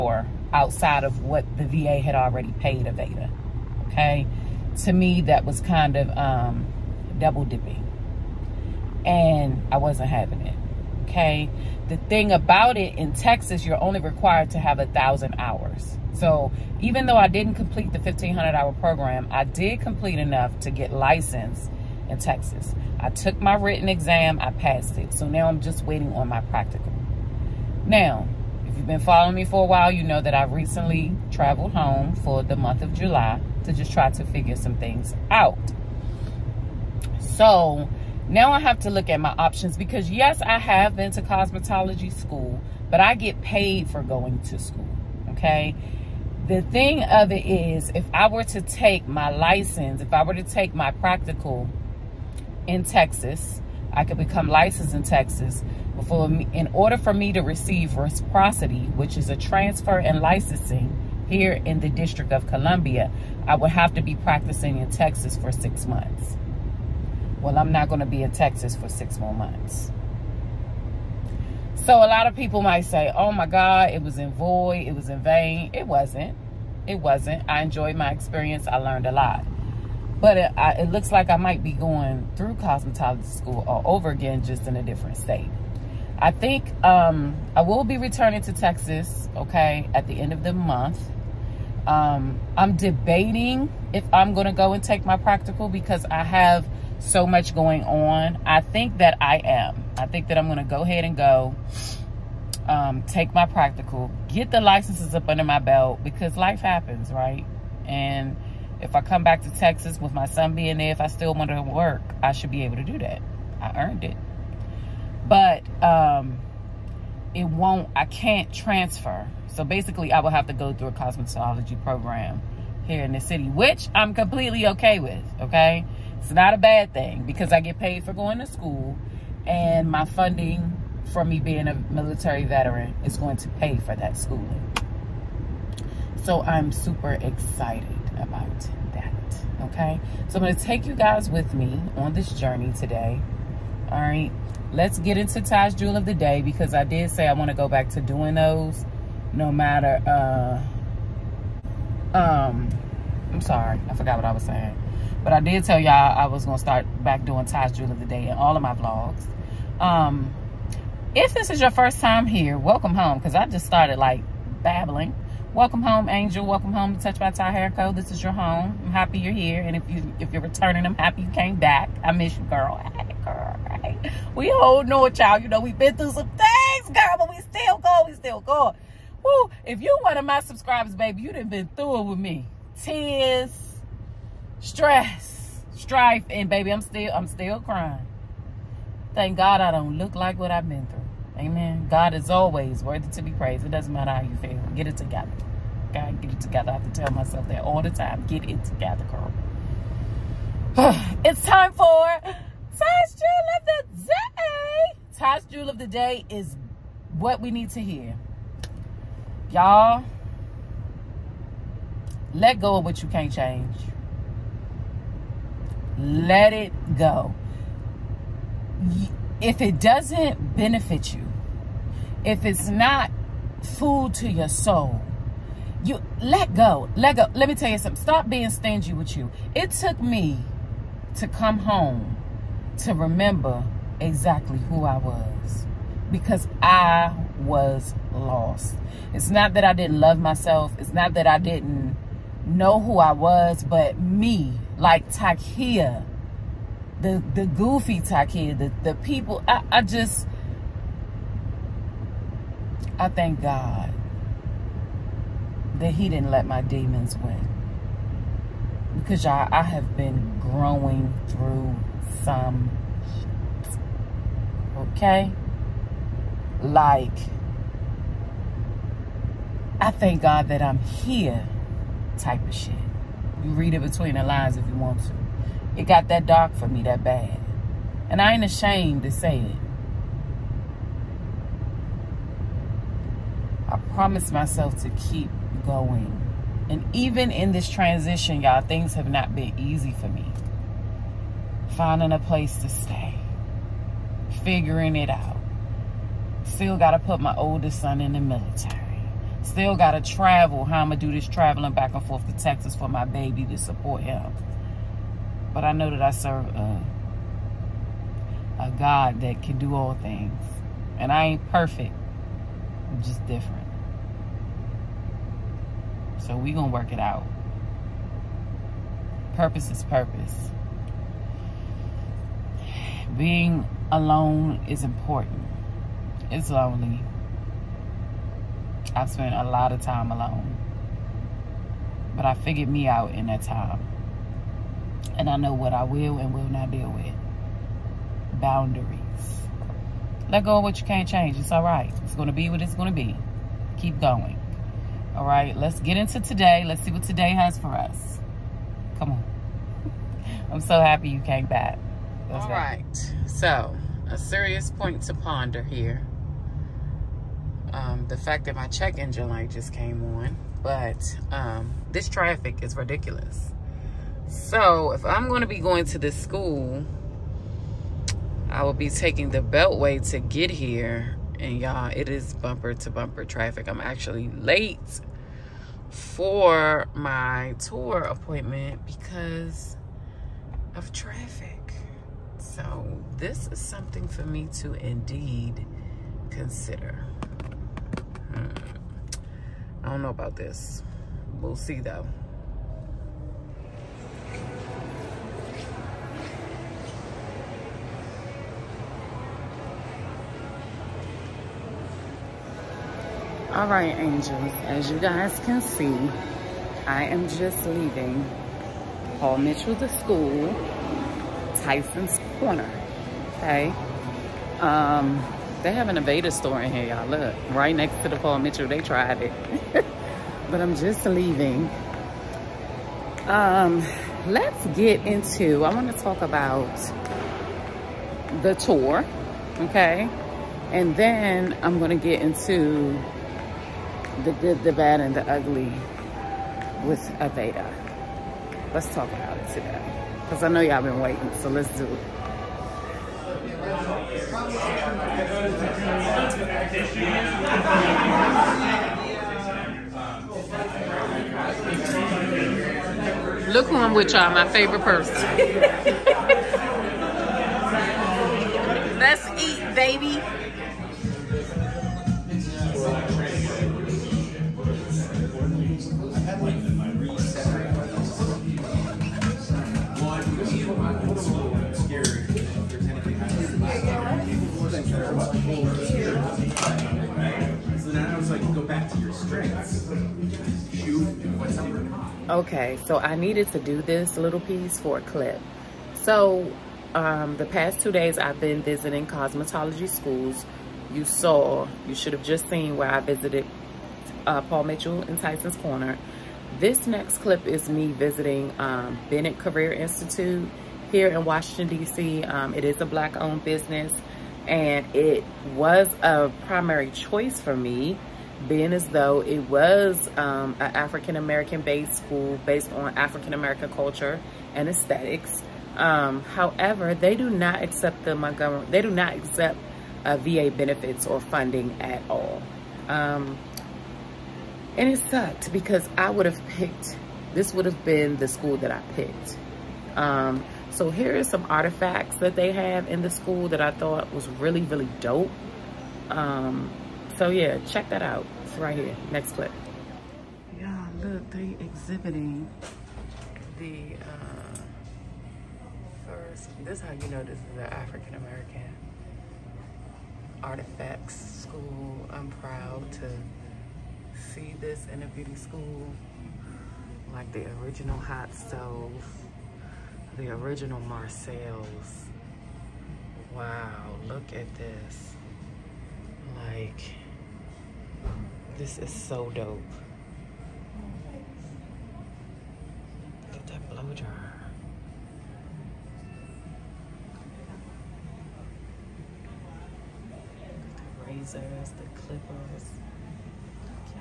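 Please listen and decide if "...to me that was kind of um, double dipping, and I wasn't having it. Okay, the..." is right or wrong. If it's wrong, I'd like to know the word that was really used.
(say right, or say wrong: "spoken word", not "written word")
right.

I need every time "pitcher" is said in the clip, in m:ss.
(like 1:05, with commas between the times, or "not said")
not said.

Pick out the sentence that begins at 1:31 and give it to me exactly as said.
Um, I'm debating if I'm going to go and take my practical because I have so much going on.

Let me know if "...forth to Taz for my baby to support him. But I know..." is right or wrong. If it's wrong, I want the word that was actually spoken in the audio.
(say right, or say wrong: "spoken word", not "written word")
wrong: "Texas", not "Taz".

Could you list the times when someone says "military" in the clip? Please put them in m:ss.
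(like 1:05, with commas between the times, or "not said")
2:11, 4:58.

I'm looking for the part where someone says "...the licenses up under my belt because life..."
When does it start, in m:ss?
1:44.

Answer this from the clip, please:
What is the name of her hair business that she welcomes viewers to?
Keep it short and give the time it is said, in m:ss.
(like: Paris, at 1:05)
Touched by Ty Hair Co, at 2:47.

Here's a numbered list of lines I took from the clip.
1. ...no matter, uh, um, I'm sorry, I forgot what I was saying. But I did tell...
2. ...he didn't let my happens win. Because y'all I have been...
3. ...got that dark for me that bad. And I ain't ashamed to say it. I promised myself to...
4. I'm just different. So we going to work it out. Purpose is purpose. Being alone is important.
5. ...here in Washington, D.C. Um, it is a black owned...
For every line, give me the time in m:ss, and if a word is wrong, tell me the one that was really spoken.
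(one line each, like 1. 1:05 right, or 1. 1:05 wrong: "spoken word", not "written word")
1. 2:29 right
2. 4:15 wrong: "demons", not "happens"
3. 4:35 right
4. 5:12 right
5. 8:20 right.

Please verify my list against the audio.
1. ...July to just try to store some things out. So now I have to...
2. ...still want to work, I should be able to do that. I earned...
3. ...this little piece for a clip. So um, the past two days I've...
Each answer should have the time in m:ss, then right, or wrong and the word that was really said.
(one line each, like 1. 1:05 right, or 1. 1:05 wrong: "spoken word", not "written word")
1. 0:32 wrong: "figure", not "store"
2. 1:51 right
3. 8:03 right.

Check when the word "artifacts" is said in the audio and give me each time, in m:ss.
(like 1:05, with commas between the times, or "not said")
8:51, 9:10.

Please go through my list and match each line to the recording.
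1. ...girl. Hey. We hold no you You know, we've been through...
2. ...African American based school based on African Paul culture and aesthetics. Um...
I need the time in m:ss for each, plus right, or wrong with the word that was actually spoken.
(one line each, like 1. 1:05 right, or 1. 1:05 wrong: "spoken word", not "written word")
1. 2:53 right
2. 8:30 wrong: "American", not "Paul".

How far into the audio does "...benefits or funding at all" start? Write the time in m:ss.
8:40.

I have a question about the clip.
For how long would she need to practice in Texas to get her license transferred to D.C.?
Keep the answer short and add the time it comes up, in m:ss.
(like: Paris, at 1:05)
6 months, at 1:05.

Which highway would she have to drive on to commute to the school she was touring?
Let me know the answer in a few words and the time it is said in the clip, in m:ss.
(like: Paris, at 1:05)
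The Beltway, at 6:09.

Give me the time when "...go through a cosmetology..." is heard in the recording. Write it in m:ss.
2:00.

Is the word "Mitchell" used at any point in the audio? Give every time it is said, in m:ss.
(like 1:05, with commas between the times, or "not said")
6:49, 6:58, 8:14.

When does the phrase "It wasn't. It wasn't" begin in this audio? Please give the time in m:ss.
1:15.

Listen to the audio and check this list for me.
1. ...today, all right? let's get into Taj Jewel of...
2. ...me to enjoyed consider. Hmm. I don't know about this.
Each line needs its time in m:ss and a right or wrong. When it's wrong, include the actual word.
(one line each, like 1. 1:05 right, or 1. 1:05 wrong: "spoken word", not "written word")
1. 2:22 right
2. 6:24 wrong: "indeed", not "enjoyed".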